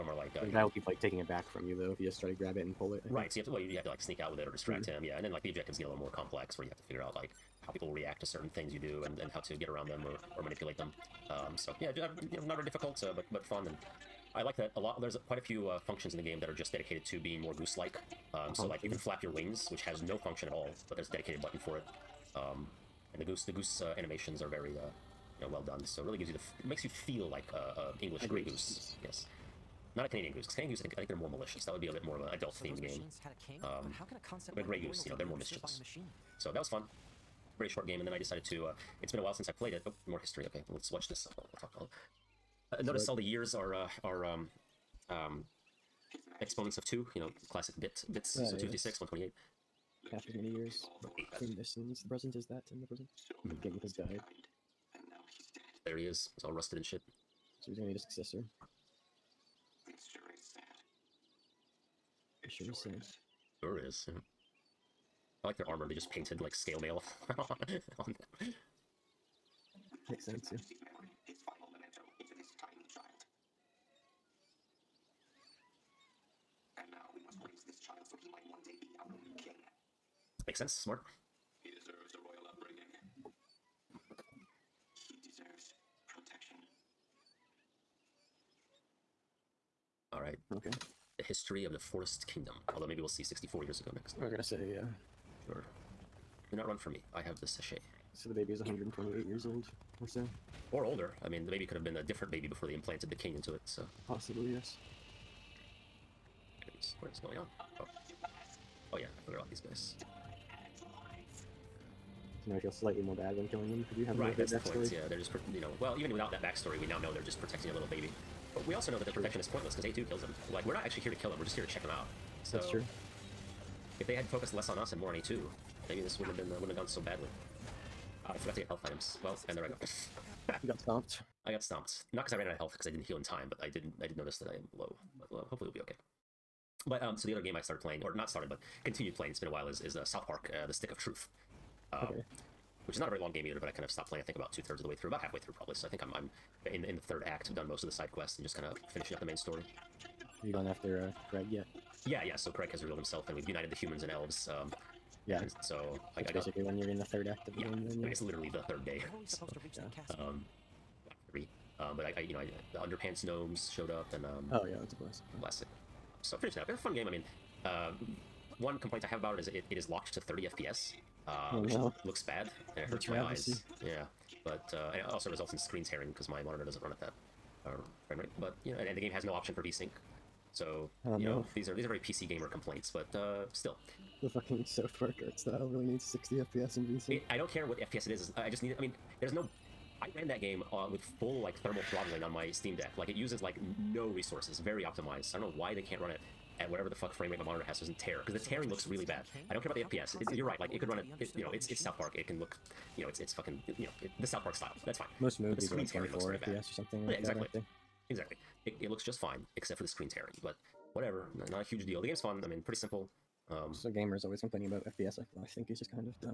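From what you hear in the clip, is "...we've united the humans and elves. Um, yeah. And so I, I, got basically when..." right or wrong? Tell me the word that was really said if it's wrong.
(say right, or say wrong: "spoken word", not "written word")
right.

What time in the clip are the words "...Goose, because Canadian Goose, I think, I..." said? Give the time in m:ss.
0:30.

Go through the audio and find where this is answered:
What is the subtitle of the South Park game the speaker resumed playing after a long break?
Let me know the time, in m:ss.
2:20.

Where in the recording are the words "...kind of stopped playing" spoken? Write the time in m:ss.
2:23.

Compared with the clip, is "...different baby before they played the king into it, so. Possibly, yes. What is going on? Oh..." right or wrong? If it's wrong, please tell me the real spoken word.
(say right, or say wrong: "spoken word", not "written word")
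wrong: "implanted", not "played".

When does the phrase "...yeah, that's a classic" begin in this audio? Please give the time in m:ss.
2:44.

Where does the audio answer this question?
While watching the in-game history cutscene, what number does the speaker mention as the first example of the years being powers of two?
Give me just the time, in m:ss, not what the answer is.
0:48.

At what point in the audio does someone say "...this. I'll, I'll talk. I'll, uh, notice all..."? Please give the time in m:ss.
0:41.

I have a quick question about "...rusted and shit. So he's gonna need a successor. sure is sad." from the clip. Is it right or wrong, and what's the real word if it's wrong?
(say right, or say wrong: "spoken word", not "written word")
right.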